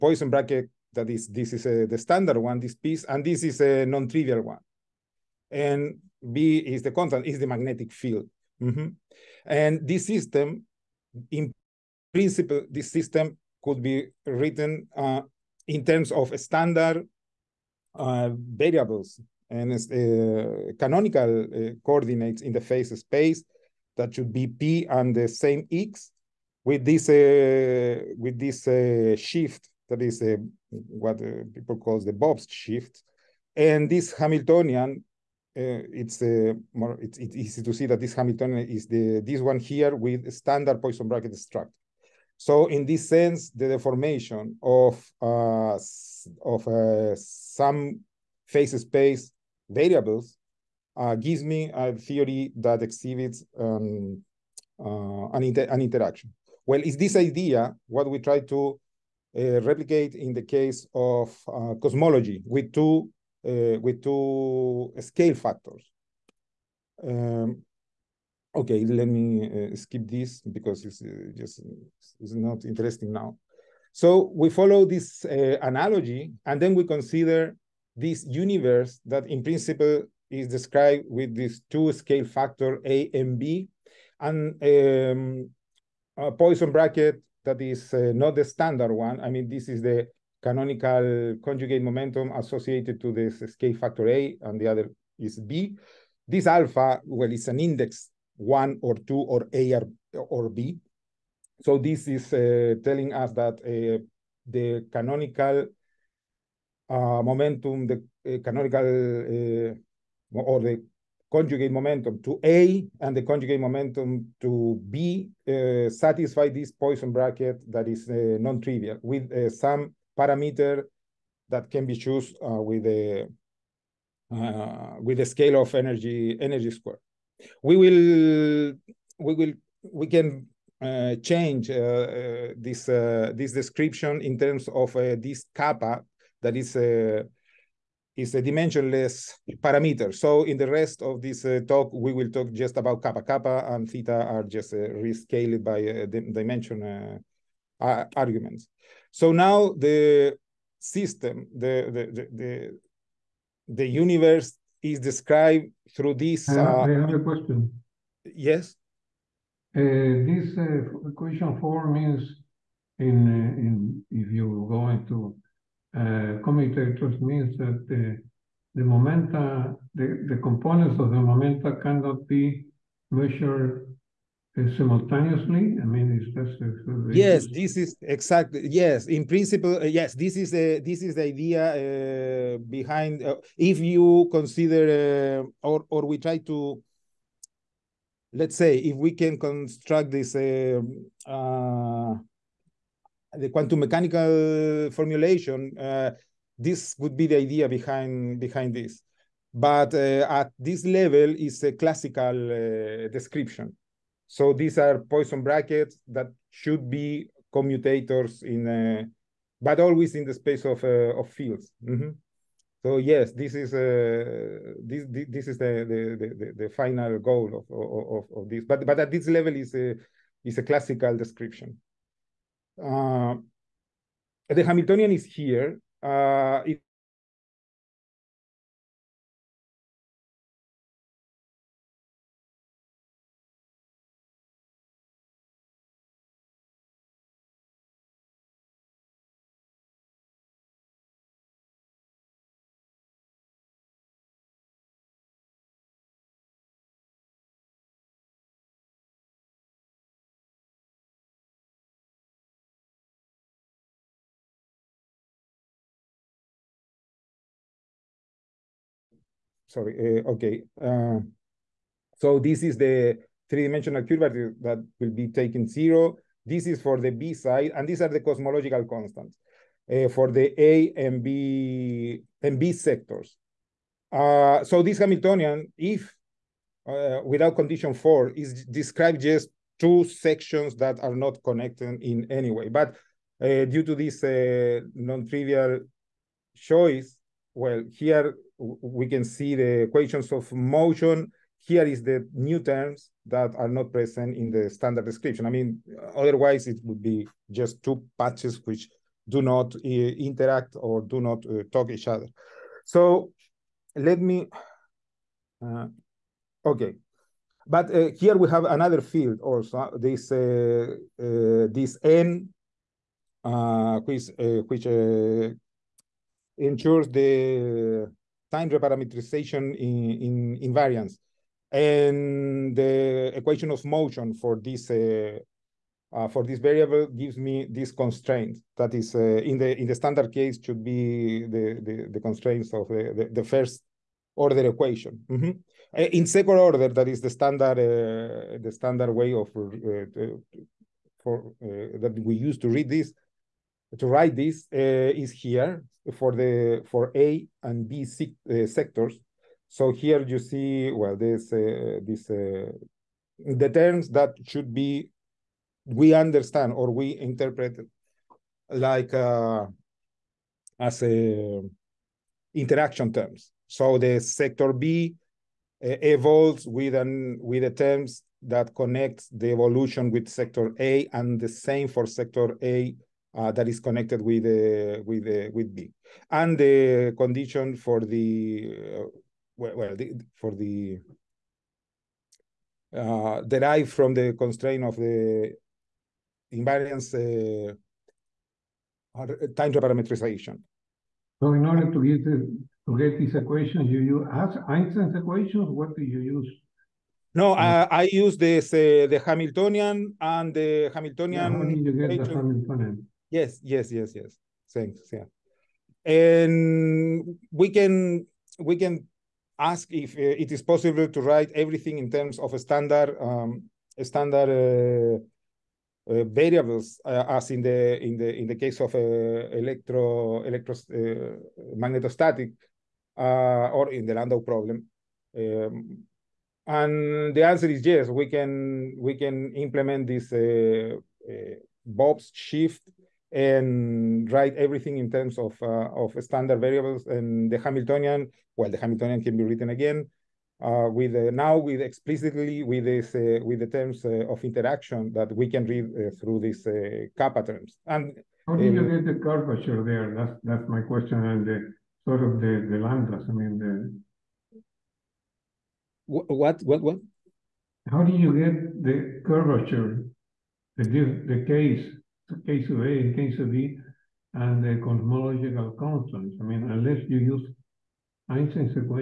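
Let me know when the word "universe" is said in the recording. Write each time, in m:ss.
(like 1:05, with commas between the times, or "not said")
1:18, 2:33.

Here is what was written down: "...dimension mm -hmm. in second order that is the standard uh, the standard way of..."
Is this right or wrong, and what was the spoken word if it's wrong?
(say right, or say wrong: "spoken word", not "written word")
wrong: "equation", not "dimension".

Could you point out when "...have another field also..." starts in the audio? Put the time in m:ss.
5:08.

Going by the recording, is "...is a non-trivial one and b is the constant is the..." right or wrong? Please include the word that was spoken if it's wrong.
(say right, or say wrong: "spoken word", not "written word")
right.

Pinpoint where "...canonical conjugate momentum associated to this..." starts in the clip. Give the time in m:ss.
1:30.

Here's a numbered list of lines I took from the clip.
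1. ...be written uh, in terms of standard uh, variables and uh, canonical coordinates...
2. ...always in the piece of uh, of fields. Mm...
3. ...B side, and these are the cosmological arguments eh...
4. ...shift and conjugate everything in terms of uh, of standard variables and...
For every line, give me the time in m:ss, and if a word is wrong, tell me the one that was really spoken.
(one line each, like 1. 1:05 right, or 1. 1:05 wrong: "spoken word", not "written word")
1. 0:13 right
2. 3:29 wrong: "space", not "piece"
3. 4:27 wrong: "constants", not "arguments"
4. 7:12 wrong: "write", not "conjugate".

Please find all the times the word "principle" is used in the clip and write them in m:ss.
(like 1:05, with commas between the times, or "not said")
0:12, 1:19, 2:59.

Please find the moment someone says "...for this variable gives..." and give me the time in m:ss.
5:26.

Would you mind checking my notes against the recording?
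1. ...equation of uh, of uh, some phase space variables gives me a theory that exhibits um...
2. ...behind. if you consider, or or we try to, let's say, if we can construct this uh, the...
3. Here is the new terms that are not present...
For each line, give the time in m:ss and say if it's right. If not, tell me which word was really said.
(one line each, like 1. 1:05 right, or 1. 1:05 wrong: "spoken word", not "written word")
1. 0:43 wrong: "deformation", not "equation"
2. 3:02 right
3. 4:51 right.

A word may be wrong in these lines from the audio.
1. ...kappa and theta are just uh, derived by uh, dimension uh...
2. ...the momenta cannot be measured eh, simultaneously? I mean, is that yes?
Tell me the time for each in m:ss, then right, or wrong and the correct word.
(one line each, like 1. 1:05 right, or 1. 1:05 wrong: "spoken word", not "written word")
1. 2:23 wrong: "rescaled", not "derived"
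2. 2:51 right.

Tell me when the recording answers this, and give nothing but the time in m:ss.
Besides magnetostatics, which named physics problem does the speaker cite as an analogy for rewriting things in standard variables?
7:04.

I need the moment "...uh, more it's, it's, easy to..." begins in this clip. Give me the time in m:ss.
0:36.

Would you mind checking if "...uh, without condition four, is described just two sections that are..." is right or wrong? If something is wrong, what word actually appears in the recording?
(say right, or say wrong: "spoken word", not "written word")
right.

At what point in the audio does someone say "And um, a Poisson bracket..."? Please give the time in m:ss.
1:24.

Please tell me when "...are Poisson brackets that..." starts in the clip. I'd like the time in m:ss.
3:24.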